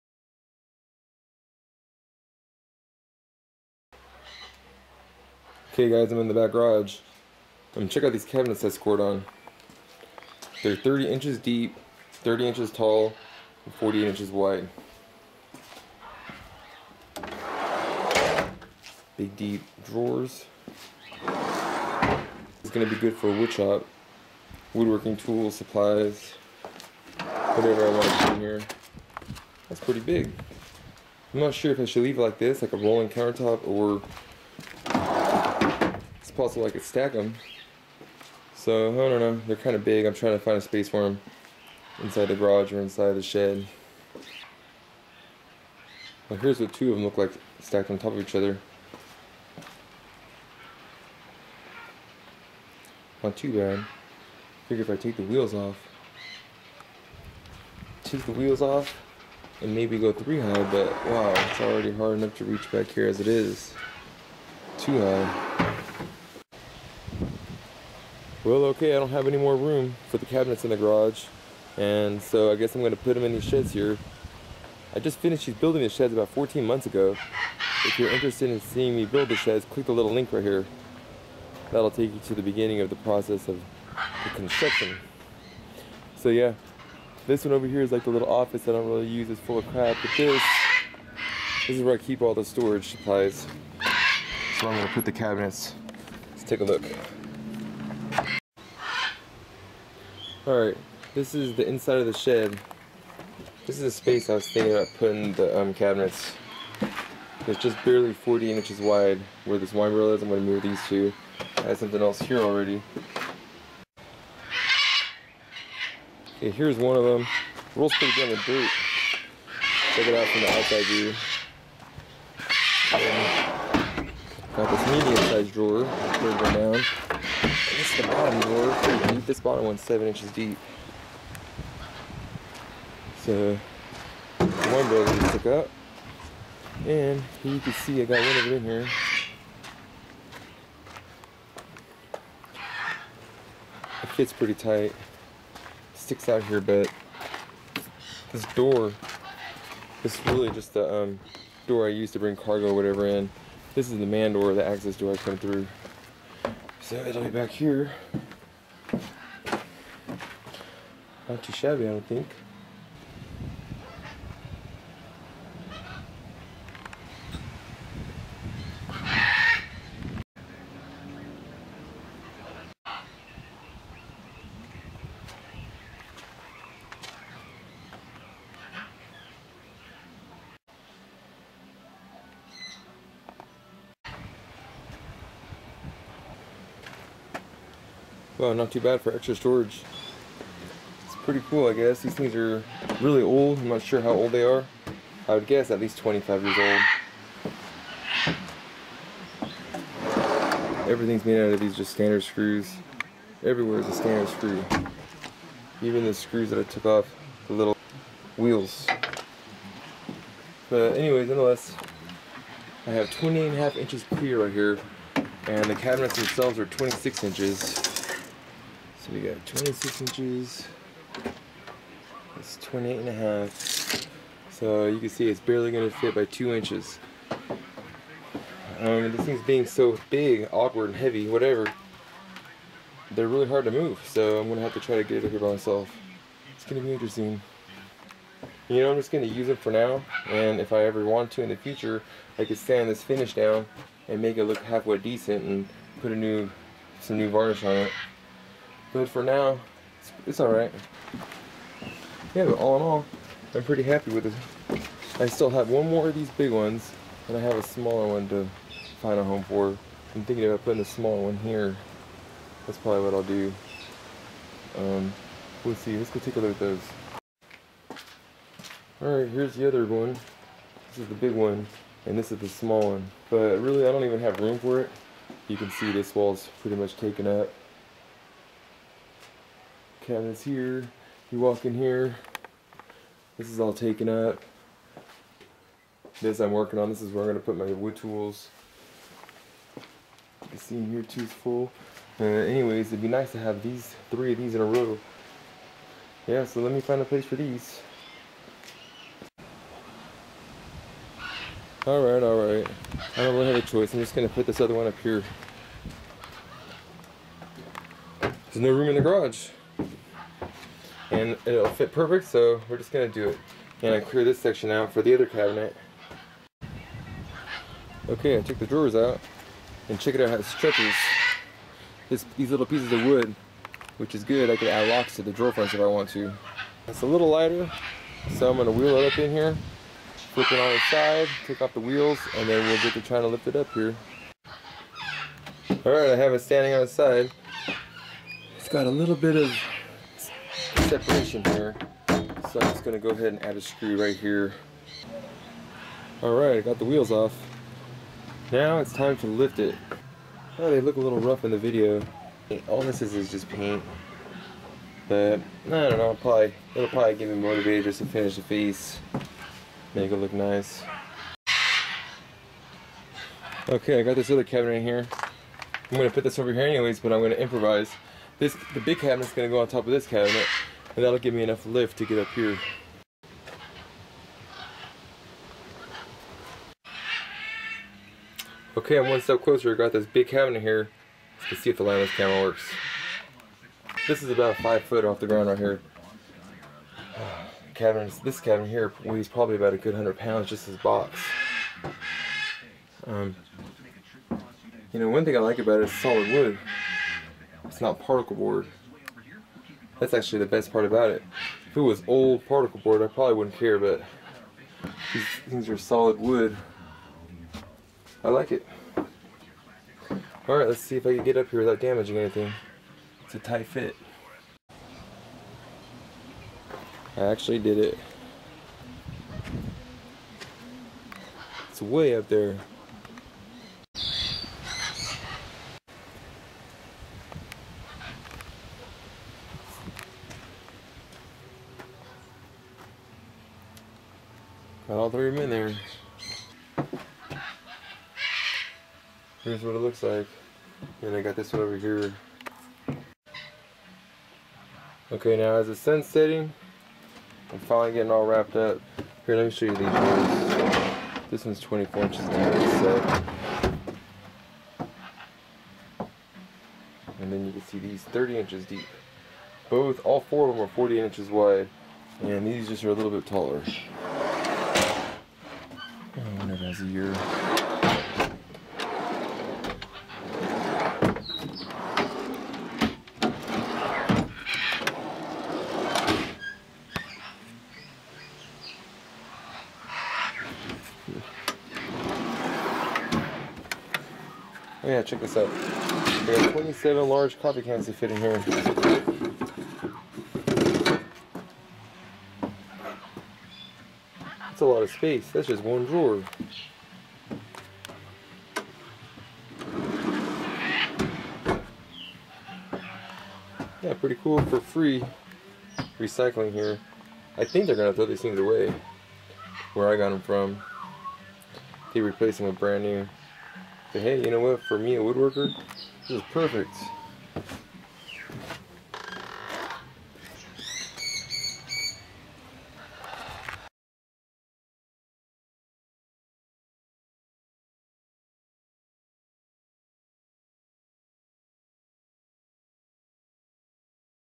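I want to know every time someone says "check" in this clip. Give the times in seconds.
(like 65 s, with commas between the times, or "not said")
7 s, 119 s, 319 s, 485 s.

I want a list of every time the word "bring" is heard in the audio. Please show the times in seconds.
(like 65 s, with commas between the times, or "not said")
152 s.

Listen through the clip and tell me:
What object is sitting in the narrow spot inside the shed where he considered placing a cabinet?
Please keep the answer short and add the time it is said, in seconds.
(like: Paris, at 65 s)
wine barrel, at 109 s.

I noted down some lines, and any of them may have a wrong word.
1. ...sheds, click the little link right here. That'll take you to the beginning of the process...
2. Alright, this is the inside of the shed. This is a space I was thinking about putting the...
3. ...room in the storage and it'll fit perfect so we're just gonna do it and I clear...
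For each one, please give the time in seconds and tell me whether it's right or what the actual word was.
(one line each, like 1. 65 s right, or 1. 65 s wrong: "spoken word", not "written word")
1. 79 s right
2. 100 s right
3. 308 s wrong: "garage", not "storage".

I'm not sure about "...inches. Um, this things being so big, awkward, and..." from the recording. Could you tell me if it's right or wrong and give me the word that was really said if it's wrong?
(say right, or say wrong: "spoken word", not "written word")
right.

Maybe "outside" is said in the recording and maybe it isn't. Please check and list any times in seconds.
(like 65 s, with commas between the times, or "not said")
120 s.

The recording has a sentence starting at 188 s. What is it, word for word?
Well, not too bad for extra storage.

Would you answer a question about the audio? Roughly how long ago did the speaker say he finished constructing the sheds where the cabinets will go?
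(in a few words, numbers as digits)
14 months.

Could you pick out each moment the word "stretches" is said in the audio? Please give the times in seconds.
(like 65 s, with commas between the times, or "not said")
320 s.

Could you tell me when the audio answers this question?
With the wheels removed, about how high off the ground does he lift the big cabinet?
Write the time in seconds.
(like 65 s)
384 s.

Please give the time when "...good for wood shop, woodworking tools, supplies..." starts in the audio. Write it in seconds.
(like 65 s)
22 s.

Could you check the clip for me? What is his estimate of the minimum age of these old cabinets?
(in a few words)
25 years.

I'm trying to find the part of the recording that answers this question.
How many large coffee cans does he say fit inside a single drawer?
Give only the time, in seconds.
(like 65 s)
486 s.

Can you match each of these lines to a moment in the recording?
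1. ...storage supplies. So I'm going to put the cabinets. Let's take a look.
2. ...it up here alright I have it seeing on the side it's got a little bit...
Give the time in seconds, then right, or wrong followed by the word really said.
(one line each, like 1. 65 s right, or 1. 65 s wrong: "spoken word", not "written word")
1. 92 s right
2. 333 s wrong: "standing", not "seeing".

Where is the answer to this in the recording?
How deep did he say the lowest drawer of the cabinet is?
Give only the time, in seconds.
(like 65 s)
129 s.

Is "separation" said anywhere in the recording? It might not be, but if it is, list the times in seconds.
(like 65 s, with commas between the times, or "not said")
340 s.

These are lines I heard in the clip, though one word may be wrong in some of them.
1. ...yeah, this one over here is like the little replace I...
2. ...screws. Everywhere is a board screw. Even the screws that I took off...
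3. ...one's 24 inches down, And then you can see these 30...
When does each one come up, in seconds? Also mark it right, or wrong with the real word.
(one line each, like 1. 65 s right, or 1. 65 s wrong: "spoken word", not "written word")
1. 86 s wrong: "office", not "replace"
2. 202 s wrong: "standard", not "board"
3. 451 s right.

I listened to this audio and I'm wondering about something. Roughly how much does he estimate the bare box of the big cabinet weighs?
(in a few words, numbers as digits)
100 pounds.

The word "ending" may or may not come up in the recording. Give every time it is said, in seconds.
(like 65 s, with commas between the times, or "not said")
not said.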